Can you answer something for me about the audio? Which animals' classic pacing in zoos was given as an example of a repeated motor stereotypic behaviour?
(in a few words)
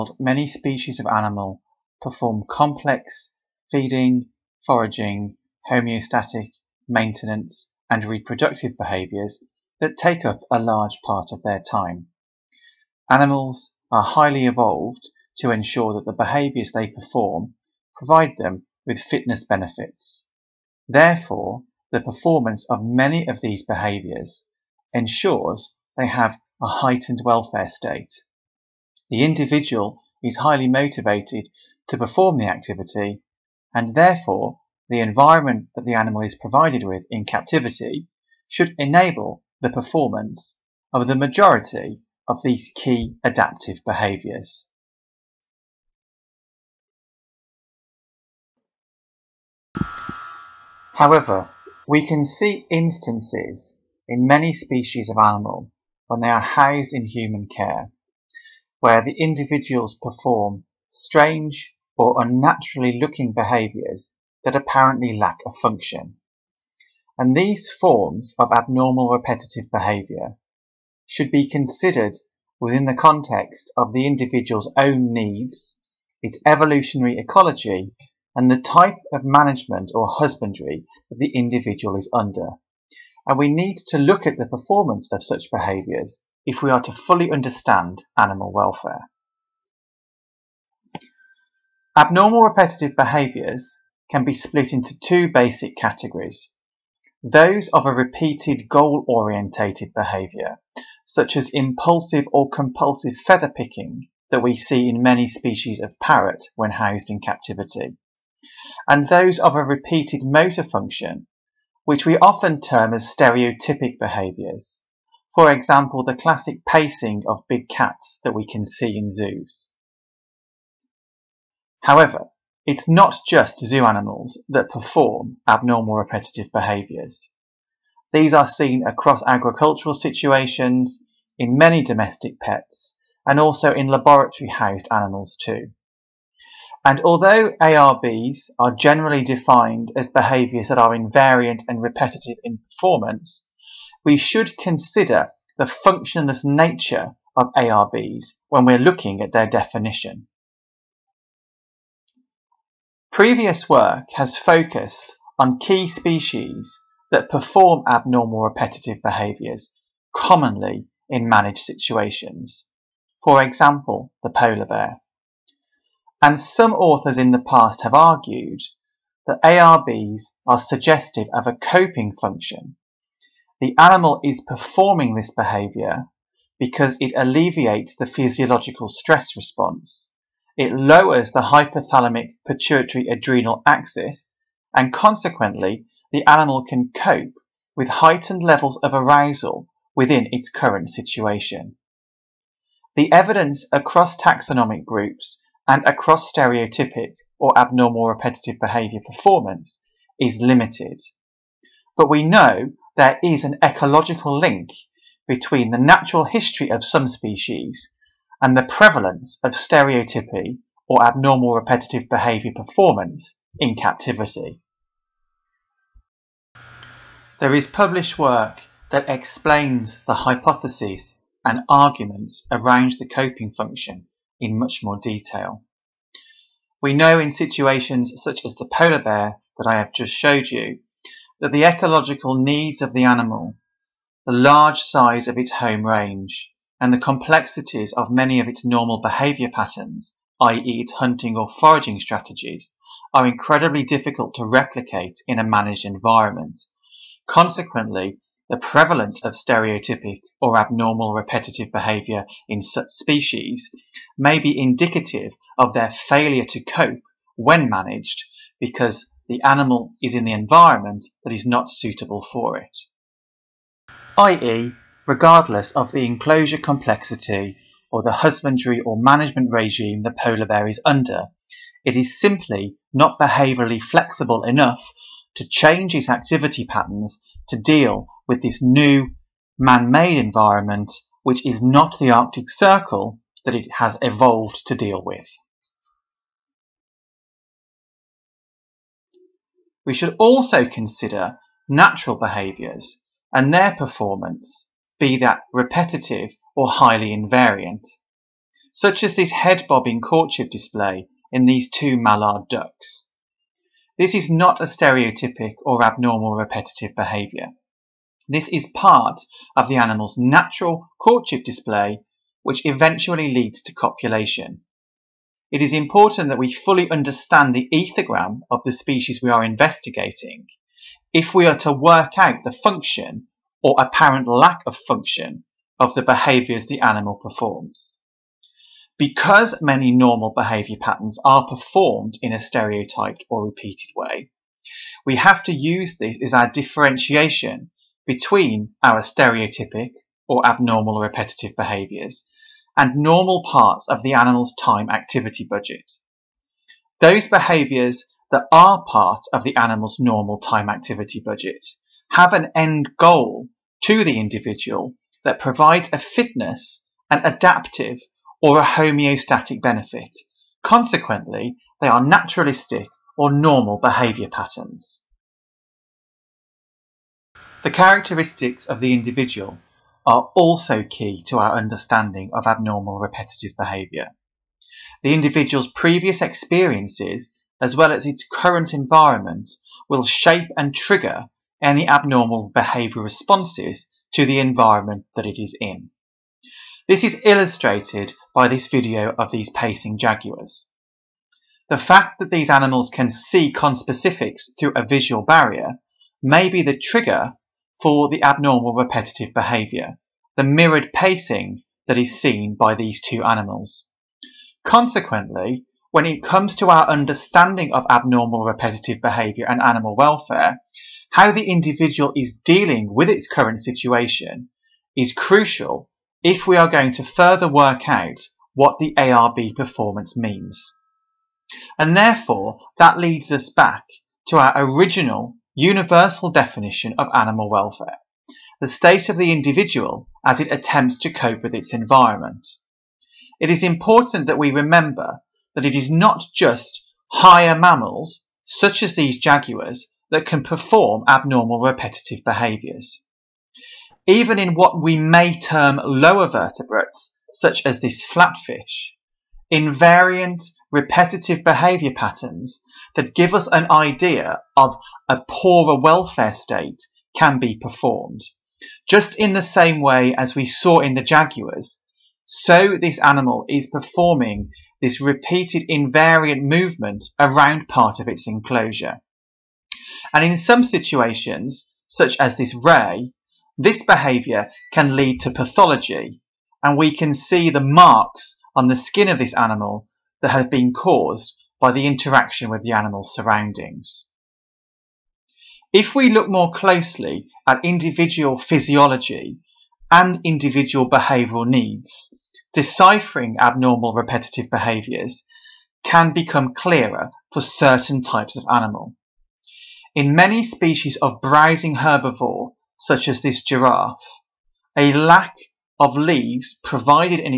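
Big cats.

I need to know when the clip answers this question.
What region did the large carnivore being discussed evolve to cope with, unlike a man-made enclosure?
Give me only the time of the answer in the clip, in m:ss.
4:42.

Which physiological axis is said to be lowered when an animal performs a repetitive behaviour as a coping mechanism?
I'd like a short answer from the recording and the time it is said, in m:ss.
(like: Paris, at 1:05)
Hypothalamic pituitary adrenal axis, at 3:01.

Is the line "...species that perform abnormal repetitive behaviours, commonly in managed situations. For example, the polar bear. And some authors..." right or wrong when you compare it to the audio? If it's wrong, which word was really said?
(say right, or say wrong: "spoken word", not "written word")
right.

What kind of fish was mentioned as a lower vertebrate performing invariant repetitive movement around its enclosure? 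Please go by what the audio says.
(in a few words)
Flatfish.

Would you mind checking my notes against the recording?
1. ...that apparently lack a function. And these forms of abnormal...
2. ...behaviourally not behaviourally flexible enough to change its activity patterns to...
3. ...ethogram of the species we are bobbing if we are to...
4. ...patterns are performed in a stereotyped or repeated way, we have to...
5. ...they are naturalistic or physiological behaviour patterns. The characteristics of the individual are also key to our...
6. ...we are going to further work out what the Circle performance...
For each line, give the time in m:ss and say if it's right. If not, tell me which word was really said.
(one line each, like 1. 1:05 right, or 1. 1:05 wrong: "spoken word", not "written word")
1. 1:04 right
2. 4:32 wrong: "simply", not "behaviourally"
3. 5:17 wrong: "investigating", not "bobbing"
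4. 5:30 right
5. 6:01 wrong: "normal", not "physiological"
6. 6:56 wrong: "ARB", not "Circle".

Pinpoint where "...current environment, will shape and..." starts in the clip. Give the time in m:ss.
6:18.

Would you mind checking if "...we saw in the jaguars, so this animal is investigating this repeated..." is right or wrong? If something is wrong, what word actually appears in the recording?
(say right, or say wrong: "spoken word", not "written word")
wrong: "performing", not "investigating".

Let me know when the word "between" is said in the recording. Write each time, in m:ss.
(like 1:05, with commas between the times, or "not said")
3:25, 5:38.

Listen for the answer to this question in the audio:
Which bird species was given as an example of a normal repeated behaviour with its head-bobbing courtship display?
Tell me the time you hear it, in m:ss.
5:01.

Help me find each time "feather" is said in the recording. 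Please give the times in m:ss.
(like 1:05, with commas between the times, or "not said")
1:43.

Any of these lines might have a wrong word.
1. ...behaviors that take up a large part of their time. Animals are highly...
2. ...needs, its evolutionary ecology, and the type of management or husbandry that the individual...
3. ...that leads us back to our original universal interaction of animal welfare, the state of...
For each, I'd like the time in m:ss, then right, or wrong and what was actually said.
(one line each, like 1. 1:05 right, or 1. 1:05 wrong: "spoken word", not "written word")
1. 0:08 right
2. 1:15 right
3. 7:02 wrong: "definition", not "interaction".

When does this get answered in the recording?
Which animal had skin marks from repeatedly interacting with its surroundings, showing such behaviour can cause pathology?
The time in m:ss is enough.
7:52.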